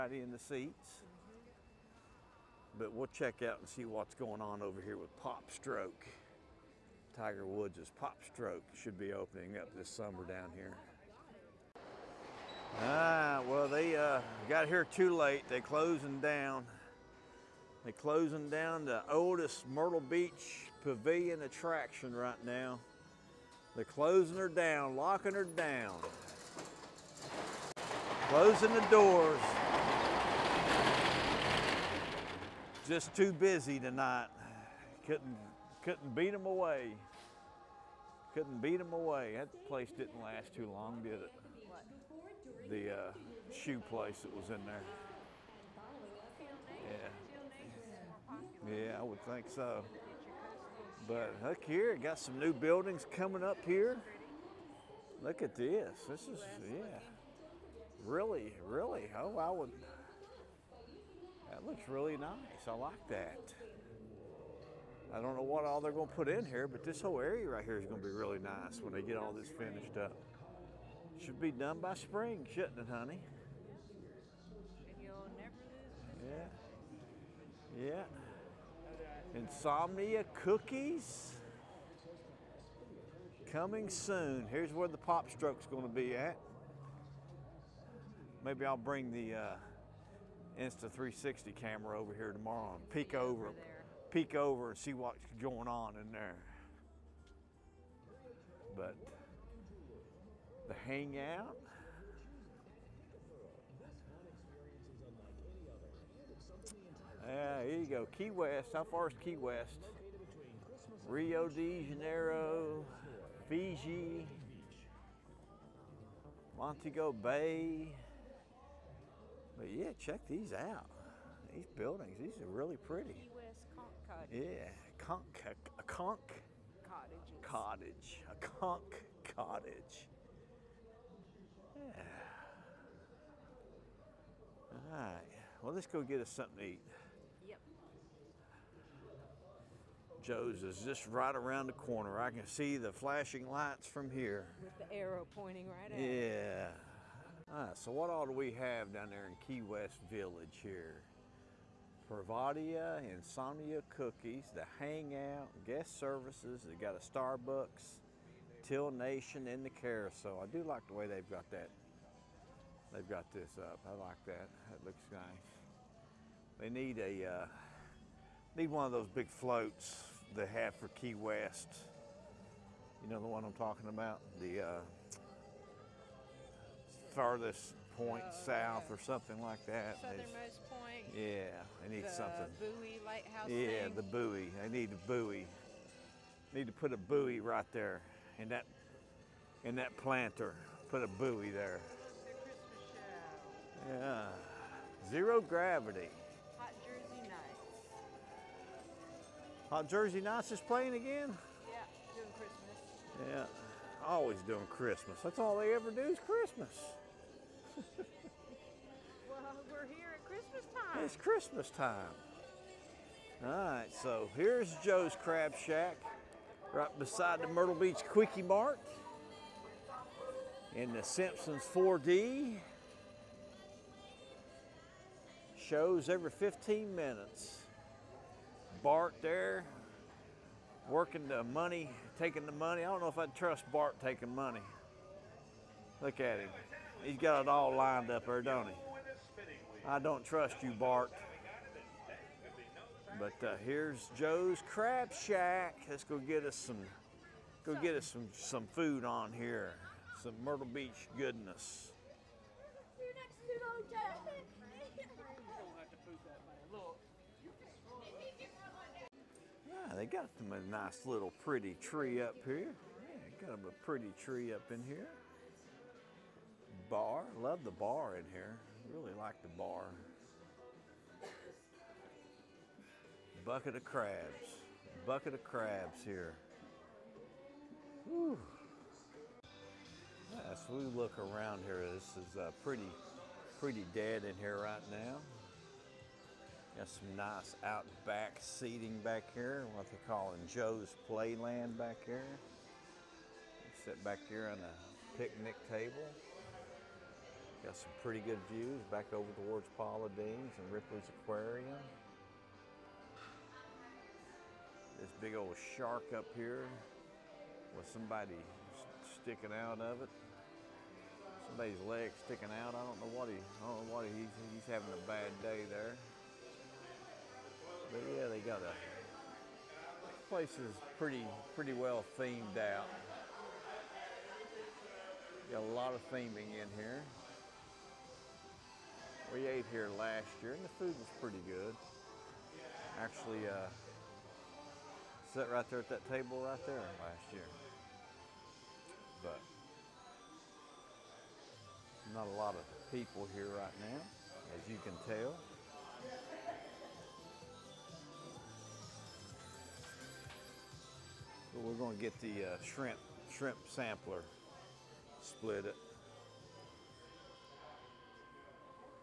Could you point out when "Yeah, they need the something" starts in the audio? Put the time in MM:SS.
03:01.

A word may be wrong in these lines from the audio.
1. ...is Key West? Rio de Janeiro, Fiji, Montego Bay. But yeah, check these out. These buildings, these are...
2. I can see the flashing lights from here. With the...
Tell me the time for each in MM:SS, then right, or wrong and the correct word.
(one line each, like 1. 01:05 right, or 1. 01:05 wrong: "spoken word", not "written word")
1. 01:49 right
2. 02:22 right.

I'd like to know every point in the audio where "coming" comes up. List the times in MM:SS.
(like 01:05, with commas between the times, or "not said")
00:53, 01:23.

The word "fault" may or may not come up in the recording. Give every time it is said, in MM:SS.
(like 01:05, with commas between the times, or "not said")
not said.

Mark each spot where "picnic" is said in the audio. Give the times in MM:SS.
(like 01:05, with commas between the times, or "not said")
04:55.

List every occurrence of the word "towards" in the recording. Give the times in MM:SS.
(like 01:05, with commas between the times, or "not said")
04:59.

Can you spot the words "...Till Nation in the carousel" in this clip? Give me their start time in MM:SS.
02:38.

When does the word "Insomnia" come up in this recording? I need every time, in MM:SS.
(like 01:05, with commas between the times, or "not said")
01:19, 02:33.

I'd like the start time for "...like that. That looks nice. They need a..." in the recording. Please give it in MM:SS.
02:43.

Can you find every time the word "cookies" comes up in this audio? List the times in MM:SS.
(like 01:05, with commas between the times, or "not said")
01:20, 02:33.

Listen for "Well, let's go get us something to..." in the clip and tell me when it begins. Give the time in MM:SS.
02:15.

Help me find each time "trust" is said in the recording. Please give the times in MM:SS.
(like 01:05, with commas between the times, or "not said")
03:53, 04:00.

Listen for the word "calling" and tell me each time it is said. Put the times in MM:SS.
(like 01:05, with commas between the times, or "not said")
04:50.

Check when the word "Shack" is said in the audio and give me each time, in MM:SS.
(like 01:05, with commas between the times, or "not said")
03:35, 04:05.